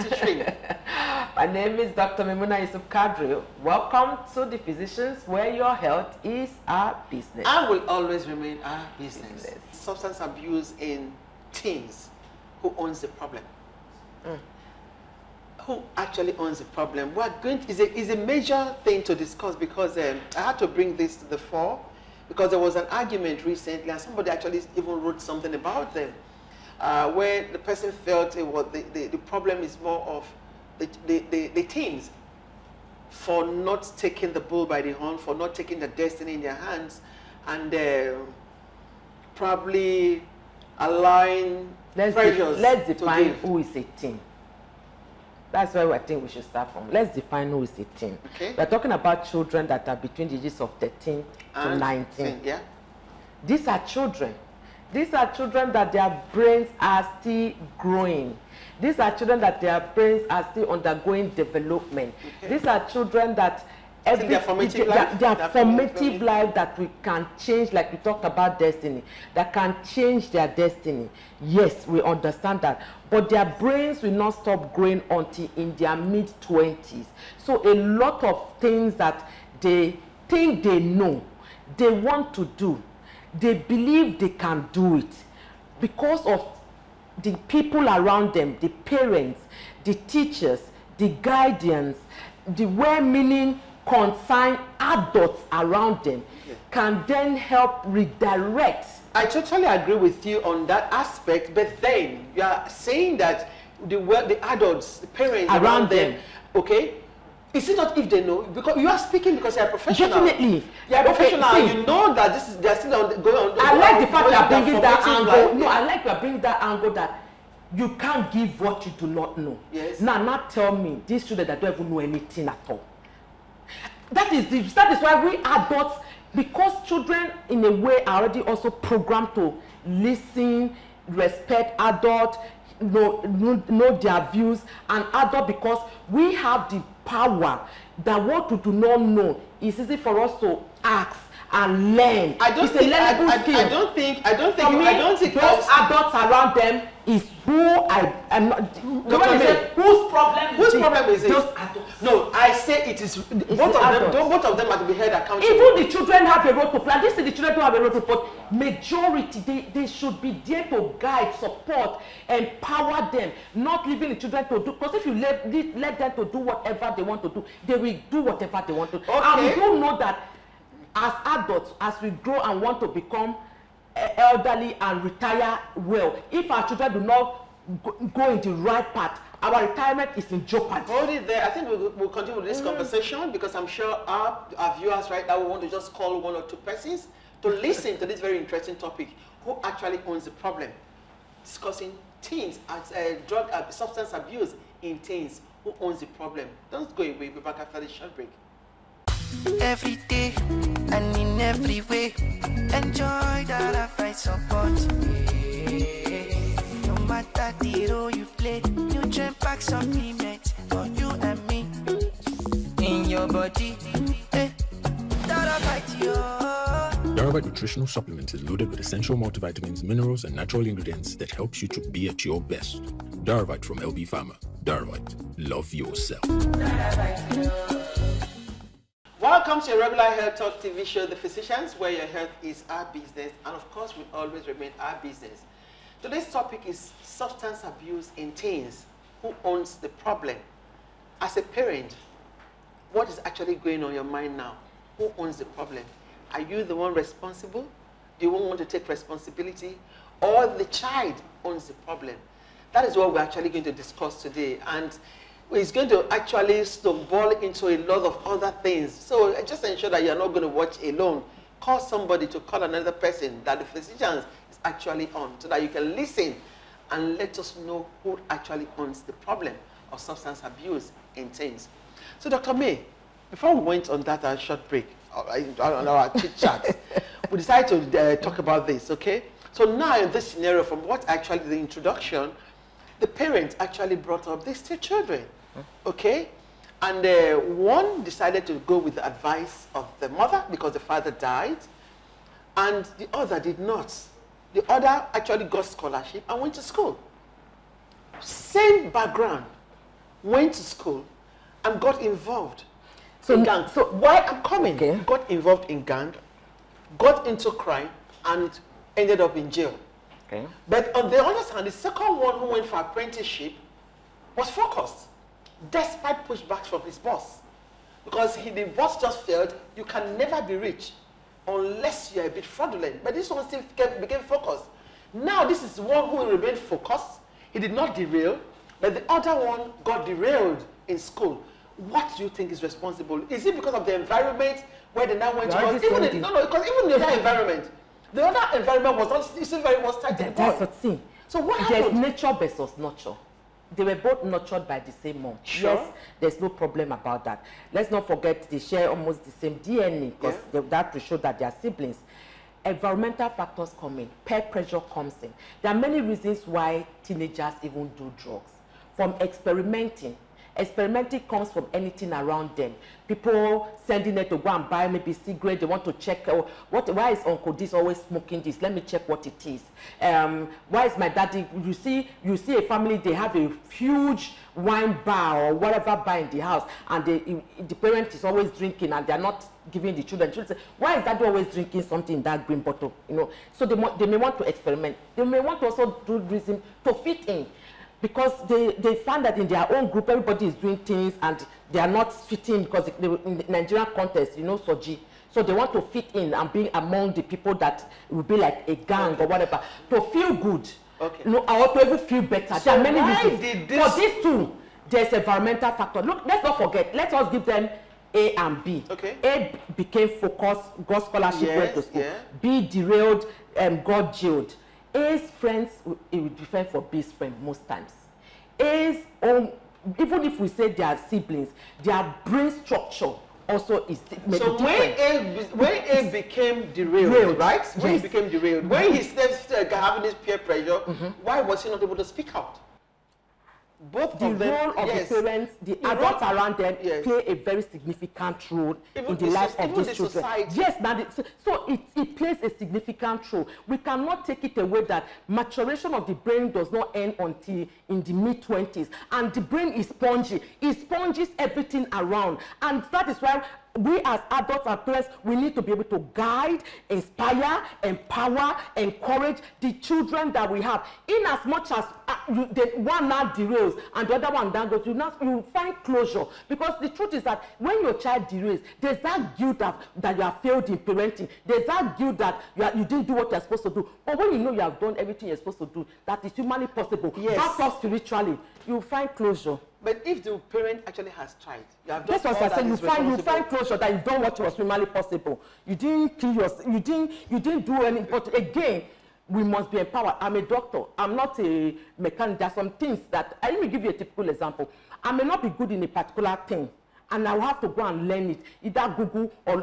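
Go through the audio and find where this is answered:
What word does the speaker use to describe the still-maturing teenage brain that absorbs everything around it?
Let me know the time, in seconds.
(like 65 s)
449 s.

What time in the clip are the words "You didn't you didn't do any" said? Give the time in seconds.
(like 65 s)
486 s.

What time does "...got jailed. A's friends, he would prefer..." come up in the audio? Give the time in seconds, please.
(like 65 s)
413 s.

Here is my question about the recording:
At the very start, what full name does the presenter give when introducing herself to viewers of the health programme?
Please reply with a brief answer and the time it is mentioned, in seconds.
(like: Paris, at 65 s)
Dr. Memuna Yusuf Kadri, at 1 s.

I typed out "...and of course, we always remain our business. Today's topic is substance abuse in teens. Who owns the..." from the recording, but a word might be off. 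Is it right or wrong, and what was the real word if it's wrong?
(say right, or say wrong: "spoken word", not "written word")
right.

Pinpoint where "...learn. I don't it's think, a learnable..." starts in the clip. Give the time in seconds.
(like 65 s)
141 s.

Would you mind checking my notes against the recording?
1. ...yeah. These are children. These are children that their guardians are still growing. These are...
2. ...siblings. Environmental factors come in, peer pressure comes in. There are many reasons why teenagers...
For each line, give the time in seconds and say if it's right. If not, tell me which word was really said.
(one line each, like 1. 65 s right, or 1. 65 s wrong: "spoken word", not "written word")
1. 52 s wrong: "brains", not "guardians"
2. 351 s right.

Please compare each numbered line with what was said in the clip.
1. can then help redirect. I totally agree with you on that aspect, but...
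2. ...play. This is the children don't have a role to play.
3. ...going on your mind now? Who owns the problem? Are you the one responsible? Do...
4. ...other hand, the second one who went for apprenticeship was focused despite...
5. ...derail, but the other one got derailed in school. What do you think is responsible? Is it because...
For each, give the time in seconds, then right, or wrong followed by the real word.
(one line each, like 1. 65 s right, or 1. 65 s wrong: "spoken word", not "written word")
1. 96 s right
2. 156 s right
3. 243 s right
4. 311 s right
5. 327 s right.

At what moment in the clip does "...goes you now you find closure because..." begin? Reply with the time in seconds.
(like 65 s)
464 s.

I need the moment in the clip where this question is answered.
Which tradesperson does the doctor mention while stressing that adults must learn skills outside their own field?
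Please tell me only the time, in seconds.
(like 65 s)
491 s.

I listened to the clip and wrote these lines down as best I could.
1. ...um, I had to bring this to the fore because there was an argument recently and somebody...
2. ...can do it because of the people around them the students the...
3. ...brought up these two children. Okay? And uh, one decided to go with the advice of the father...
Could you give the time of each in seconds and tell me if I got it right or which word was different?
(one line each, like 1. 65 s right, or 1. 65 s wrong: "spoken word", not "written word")
1. 19 s right
2. 84 s wrong: "parents", not "students"
3. 283 s wrong: "mother", not "father".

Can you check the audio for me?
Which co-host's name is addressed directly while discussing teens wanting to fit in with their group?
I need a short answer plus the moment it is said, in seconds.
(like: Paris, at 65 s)
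Soji, at 394 s.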